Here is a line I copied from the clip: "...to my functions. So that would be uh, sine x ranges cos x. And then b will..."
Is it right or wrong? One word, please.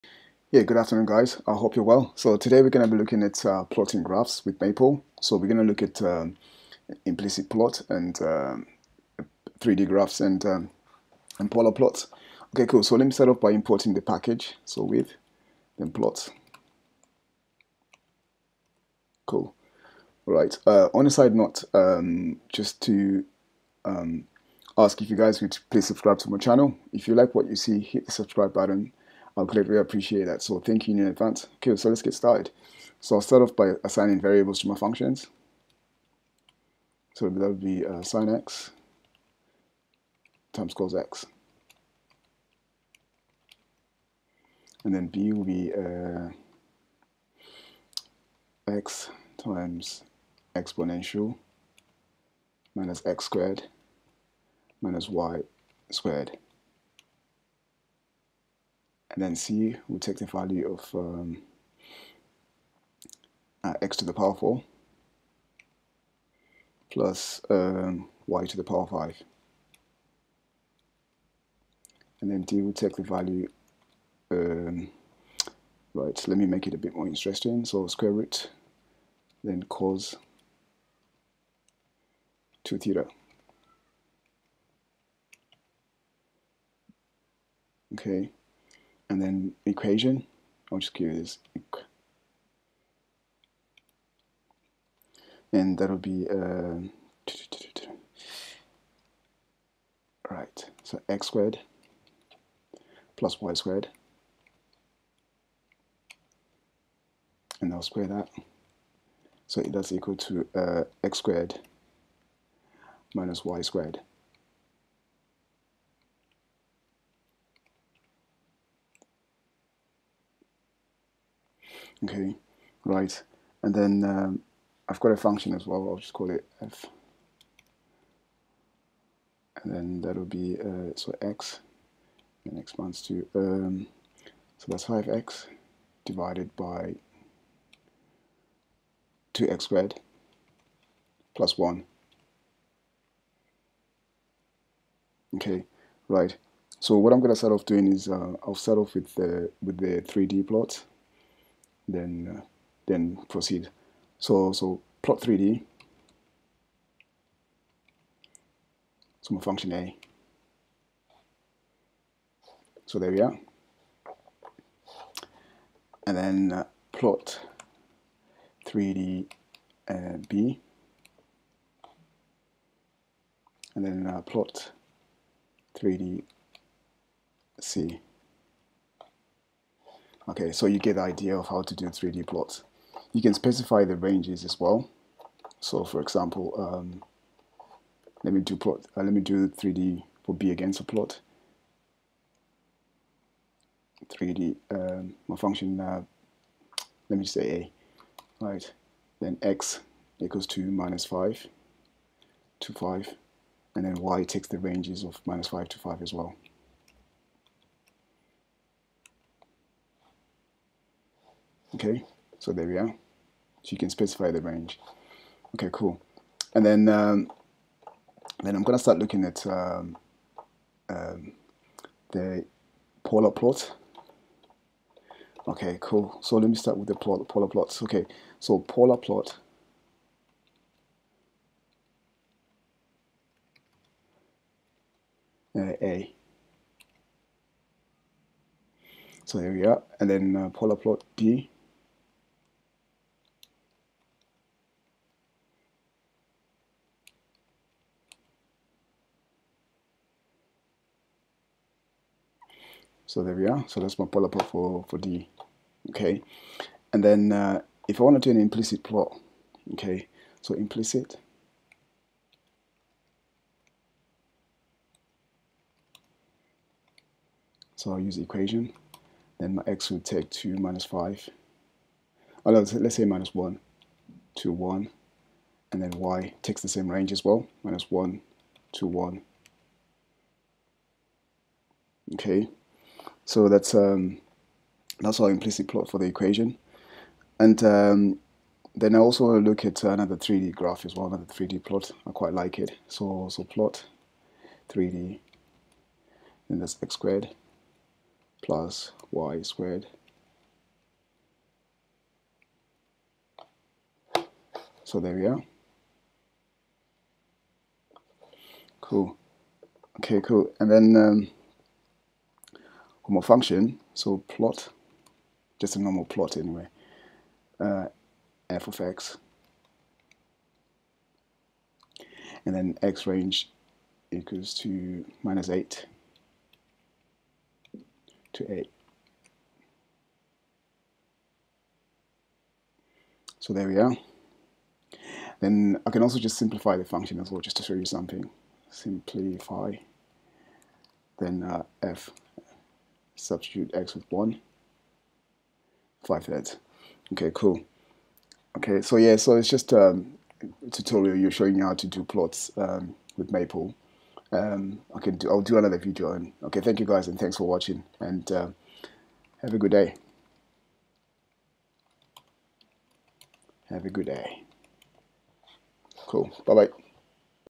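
wrong.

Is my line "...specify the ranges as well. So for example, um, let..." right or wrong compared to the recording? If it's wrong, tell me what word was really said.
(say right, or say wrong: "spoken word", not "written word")
right.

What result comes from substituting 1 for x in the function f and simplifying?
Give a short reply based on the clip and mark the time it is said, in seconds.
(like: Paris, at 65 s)
5/3, at 346 s.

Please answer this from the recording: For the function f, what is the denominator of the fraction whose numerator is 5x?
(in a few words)
2x squared plus 1.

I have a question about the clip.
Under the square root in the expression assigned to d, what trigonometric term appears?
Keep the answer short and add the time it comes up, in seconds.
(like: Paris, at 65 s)
cos 2 theta, at 79 s.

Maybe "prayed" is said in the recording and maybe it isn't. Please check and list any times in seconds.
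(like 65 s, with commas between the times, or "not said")
not said.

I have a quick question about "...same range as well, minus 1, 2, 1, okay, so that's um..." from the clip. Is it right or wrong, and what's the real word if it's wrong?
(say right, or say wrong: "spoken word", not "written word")
right.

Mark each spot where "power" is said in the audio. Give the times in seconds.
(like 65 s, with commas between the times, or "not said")
64 s, 68 s.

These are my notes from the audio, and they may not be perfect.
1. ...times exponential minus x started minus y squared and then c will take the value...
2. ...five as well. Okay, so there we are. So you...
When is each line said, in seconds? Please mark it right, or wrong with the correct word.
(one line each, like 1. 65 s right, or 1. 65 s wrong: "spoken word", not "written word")
1. 49 s wrong: "squared", not "started"
2. 205 s right.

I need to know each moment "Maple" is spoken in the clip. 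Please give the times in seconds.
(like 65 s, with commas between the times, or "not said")
4 s, 353 s.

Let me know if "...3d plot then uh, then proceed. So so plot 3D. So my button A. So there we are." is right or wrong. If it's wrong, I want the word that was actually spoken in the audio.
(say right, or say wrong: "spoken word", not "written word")
wrong: "function", not "button".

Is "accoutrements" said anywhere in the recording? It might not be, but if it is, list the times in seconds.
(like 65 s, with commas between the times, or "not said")
not said.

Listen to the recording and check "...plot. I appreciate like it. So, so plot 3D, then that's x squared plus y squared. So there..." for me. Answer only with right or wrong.
wrong.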